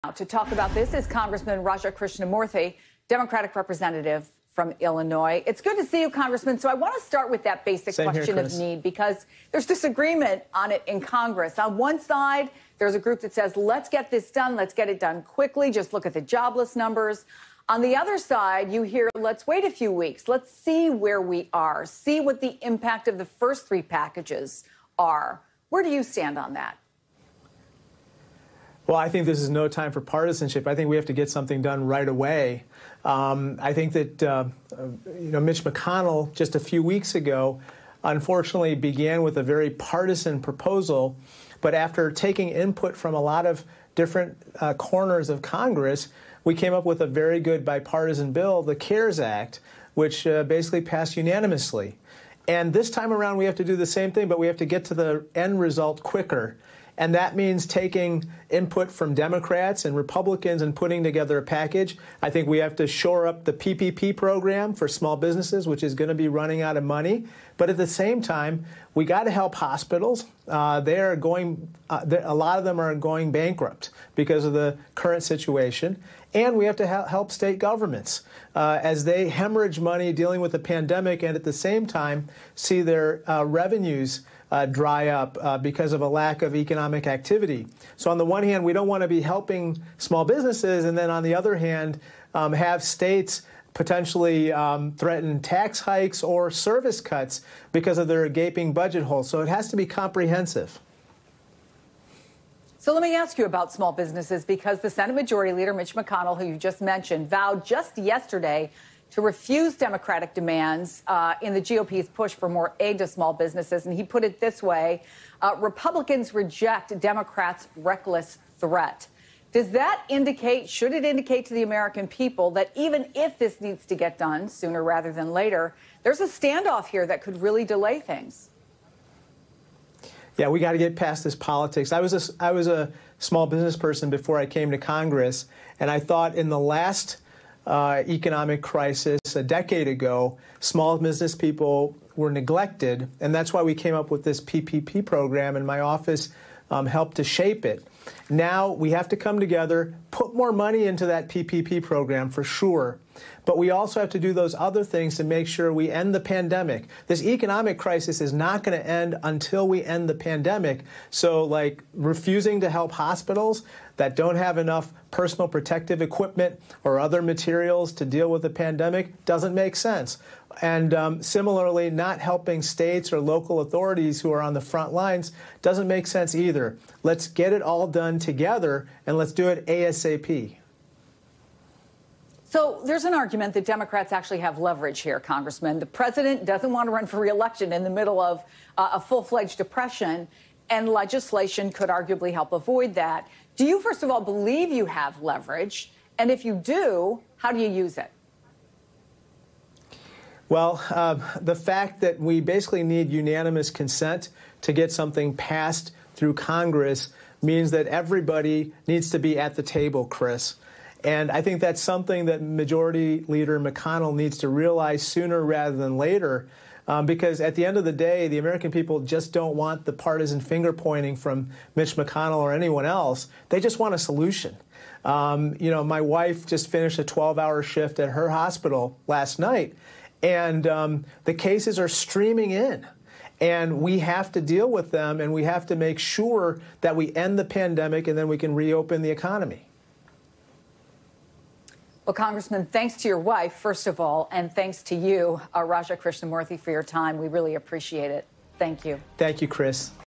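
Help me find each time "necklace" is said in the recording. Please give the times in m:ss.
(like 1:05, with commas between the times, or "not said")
not said.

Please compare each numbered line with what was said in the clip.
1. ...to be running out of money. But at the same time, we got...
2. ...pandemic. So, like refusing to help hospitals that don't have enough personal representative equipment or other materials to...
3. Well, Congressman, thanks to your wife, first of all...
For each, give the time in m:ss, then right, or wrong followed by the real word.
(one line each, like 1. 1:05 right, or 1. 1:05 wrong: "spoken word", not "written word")
1. 1:06 right
2. 2:40 wrong: "protective", not "representative"
3. 4:02 right.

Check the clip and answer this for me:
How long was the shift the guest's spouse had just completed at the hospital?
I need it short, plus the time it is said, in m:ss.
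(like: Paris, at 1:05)
12 hours, at 3:47.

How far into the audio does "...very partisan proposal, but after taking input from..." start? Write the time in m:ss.
0:39.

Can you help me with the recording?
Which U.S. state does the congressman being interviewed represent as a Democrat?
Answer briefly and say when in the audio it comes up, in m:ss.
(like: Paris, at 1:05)
Illinois, at 0:04.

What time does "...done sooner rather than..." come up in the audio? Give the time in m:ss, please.
2:04.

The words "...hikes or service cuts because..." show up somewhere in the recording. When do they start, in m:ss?
1:35.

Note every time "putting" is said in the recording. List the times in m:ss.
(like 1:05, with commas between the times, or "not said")
1:00.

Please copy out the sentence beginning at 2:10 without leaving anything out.
Yeah, we got to get past this politics.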